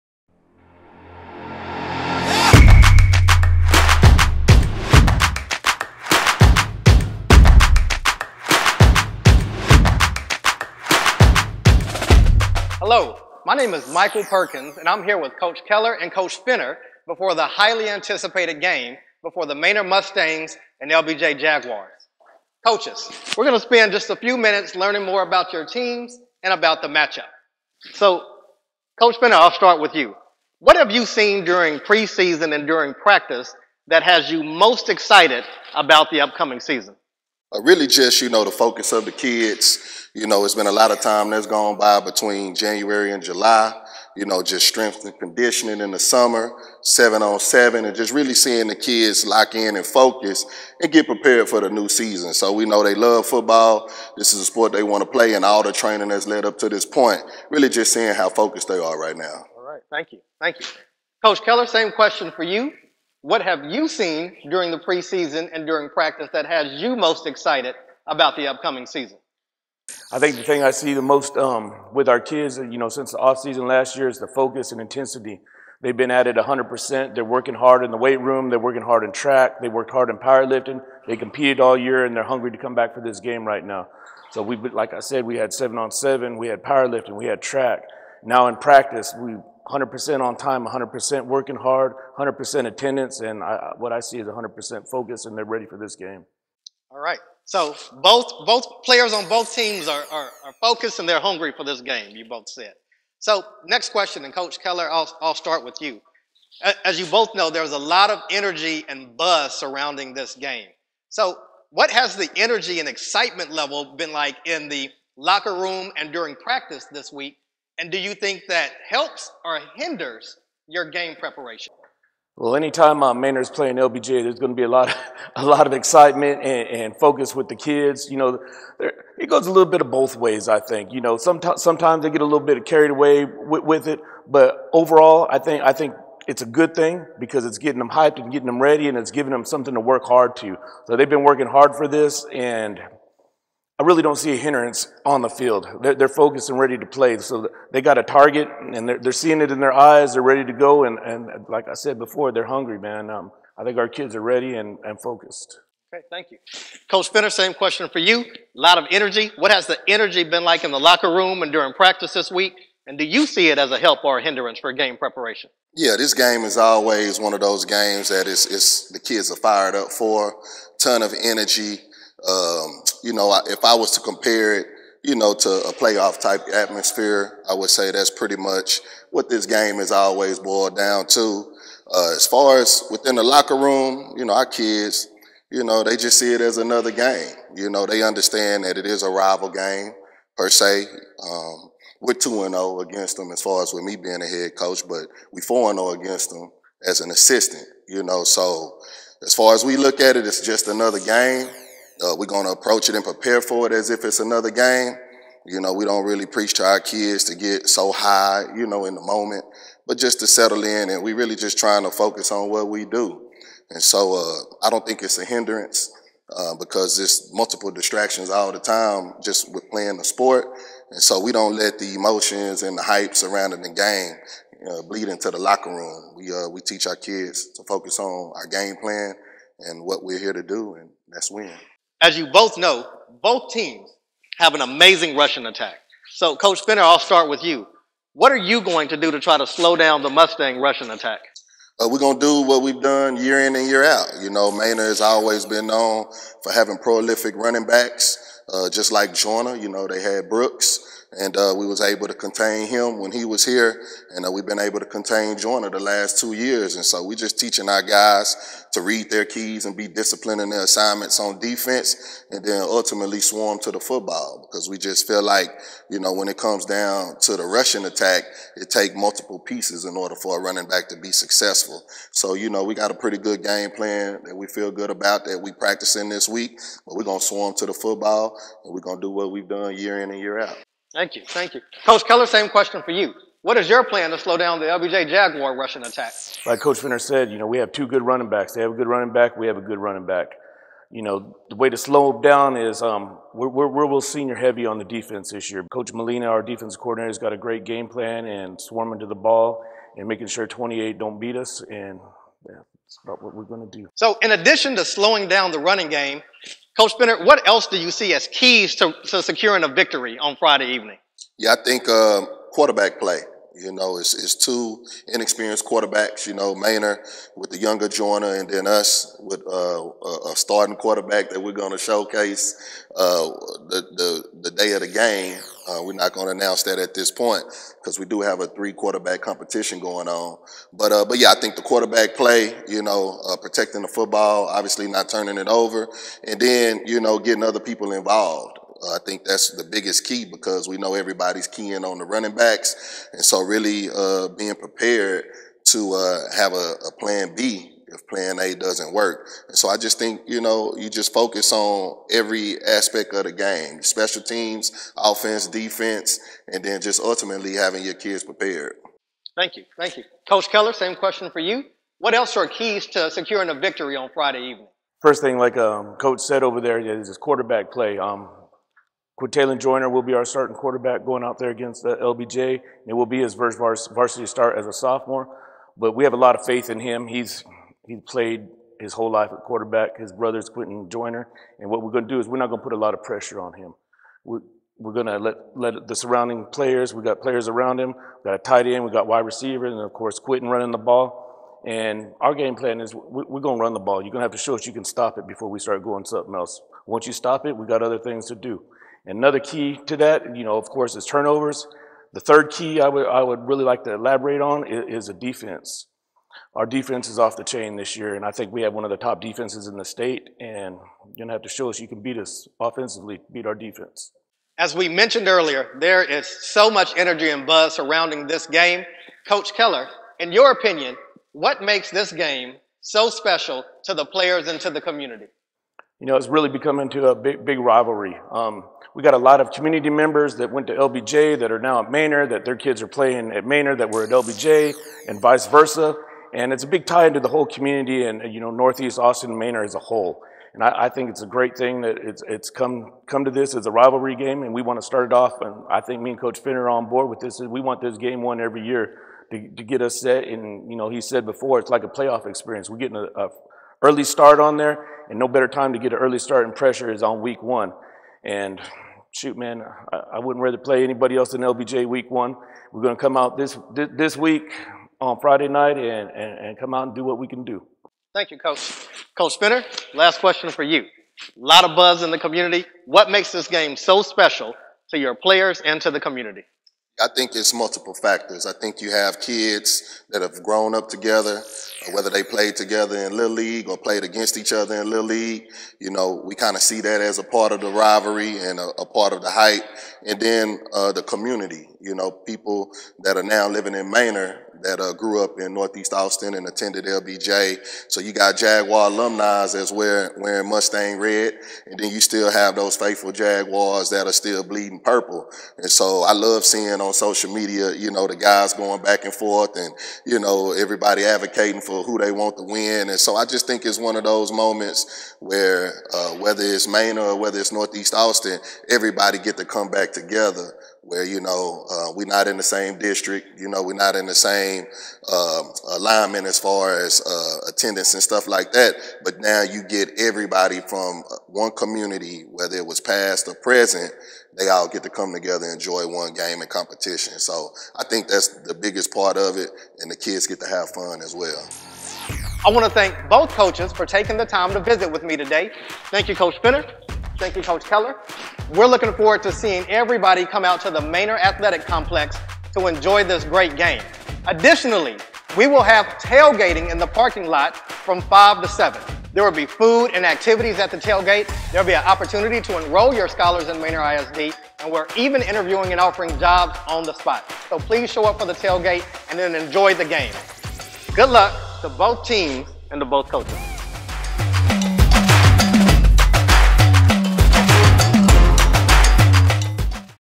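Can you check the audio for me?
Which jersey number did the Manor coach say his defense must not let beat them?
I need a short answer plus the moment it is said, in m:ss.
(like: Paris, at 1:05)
28, at 5:00.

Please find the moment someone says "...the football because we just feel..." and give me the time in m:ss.
4:23.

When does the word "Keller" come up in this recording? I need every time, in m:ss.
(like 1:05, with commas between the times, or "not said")
0:15, 1:01, 1:44, 4:42, 6:00, 6:59, 9:07.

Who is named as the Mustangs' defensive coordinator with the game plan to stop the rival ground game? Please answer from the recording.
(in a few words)
Coach Molina.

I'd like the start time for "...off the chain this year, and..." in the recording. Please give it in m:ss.
6:47.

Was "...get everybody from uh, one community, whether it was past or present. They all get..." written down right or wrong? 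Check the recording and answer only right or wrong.
right.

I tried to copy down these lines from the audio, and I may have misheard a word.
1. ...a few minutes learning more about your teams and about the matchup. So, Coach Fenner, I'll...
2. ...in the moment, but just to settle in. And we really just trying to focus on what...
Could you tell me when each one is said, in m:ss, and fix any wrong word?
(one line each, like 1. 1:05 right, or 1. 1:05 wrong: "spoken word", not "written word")
1. 0:24 right
2. 3:28 right.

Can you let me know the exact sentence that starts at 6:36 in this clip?
Once you stop it, we got other things to do.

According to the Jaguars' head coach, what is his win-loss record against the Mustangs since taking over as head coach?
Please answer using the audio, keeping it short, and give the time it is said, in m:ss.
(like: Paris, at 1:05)
2 and 0, at 3:12.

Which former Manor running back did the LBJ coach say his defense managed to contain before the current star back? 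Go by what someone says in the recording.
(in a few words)
Brooks.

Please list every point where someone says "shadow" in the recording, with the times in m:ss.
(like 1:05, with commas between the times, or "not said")
not said.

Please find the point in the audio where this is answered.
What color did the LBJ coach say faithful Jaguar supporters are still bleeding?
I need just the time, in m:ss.
8:24.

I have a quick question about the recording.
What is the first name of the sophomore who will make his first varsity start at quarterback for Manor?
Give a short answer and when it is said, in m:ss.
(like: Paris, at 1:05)
Quintalen, at 6:09.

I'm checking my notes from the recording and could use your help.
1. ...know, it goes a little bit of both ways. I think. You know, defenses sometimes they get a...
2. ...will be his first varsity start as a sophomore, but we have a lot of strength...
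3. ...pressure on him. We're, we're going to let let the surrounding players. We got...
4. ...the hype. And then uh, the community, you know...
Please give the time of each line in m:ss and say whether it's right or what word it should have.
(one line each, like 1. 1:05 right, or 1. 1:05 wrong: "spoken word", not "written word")
1. 2:08 wrong: "sometimes", not "defenses"
2. 6:12 wrong: "faith", not "strength"
3. 6:23 right
4. 8:09 right.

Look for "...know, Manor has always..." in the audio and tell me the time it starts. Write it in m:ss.
4:04.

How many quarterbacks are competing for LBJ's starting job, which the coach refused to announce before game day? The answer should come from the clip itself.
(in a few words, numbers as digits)
3.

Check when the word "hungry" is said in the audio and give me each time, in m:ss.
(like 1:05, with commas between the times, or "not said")
1:22, 1:41, 2:32.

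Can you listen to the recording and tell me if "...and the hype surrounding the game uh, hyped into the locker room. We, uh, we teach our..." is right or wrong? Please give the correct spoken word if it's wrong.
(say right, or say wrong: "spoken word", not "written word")
wrong: "bleed", not "hyped".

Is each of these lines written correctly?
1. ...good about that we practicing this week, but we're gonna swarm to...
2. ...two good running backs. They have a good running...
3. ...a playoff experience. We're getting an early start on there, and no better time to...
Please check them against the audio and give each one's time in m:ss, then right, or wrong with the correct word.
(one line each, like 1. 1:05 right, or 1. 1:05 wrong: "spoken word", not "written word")
1. 4:34 right
2. 4:47 right
3. 7:31 right.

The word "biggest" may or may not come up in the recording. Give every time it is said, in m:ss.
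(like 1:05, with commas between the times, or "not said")
5:39, 8:58.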